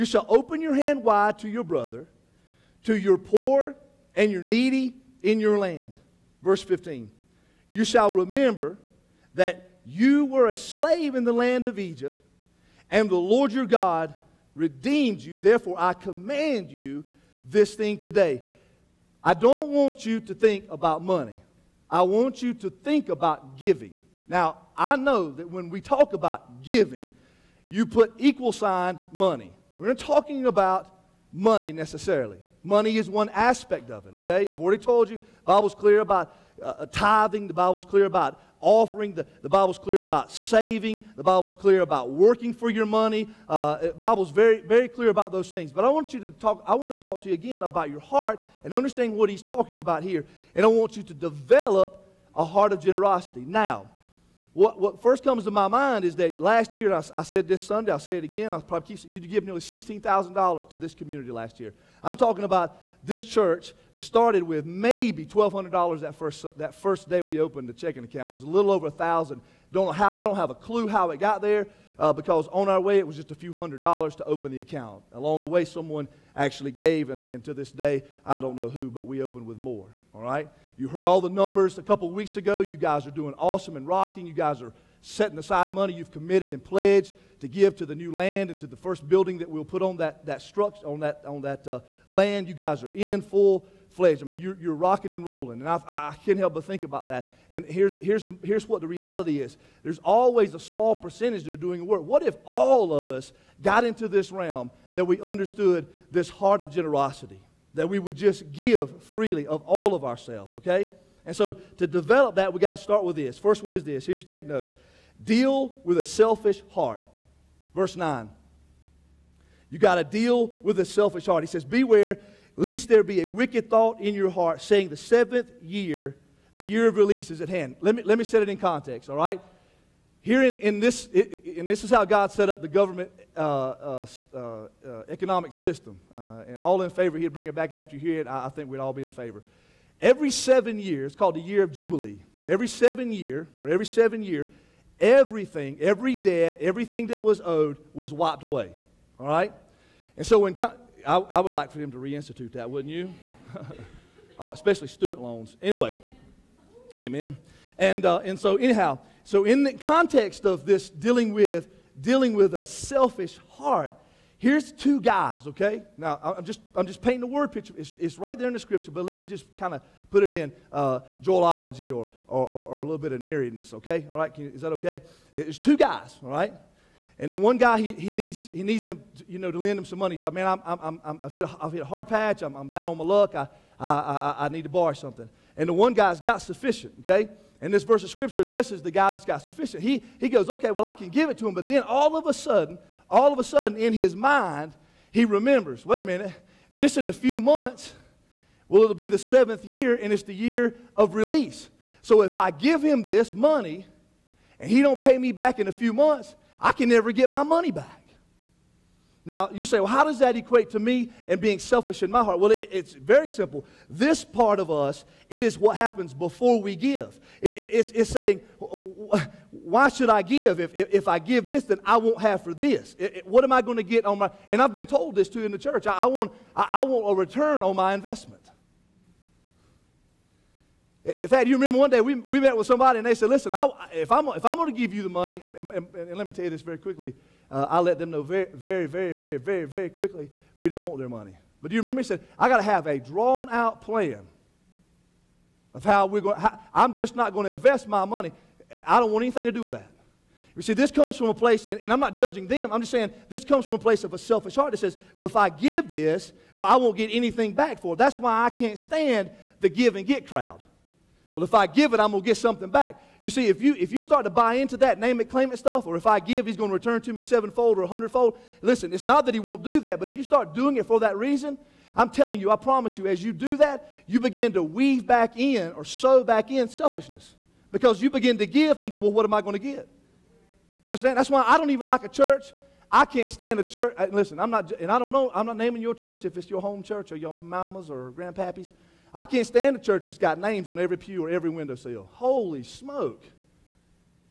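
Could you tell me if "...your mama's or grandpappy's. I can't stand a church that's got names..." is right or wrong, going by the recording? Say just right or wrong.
right.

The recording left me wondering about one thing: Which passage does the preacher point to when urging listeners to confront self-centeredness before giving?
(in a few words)
Verse 9.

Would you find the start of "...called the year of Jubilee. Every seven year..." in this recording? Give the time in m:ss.
2:21.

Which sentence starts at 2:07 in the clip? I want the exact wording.
Let me, let me set it in context, all right?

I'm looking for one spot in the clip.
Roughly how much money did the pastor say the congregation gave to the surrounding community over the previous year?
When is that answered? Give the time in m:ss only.
0:59.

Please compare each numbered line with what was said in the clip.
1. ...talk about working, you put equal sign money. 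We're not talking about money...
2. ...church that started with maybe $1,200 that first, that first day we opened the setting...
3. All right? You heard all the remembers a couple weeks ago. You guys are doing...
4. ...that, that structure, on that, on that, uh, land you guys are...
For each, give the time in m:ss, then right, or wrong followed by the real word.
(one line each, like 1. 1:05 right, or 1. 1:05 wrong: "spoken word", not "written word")
1. 0:25 wrong: "giving", not "working"
2. 1:03 wrong: "checking", not "setting"
3. 1:20 wrong: "numbers", not "remembers"
4. 1:29 right.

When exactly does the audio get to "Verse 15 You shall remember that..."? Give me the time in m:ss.
0:06.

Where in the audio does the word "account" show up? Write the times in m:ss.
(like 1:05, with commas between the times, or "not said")
1:08, 1:14.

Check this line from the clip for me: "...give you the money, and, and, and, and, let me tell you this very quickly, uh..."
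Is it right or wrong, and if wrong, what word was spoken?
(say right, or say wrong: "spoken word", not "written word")
right.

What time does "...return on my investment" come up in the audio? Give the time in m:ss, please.
3:47.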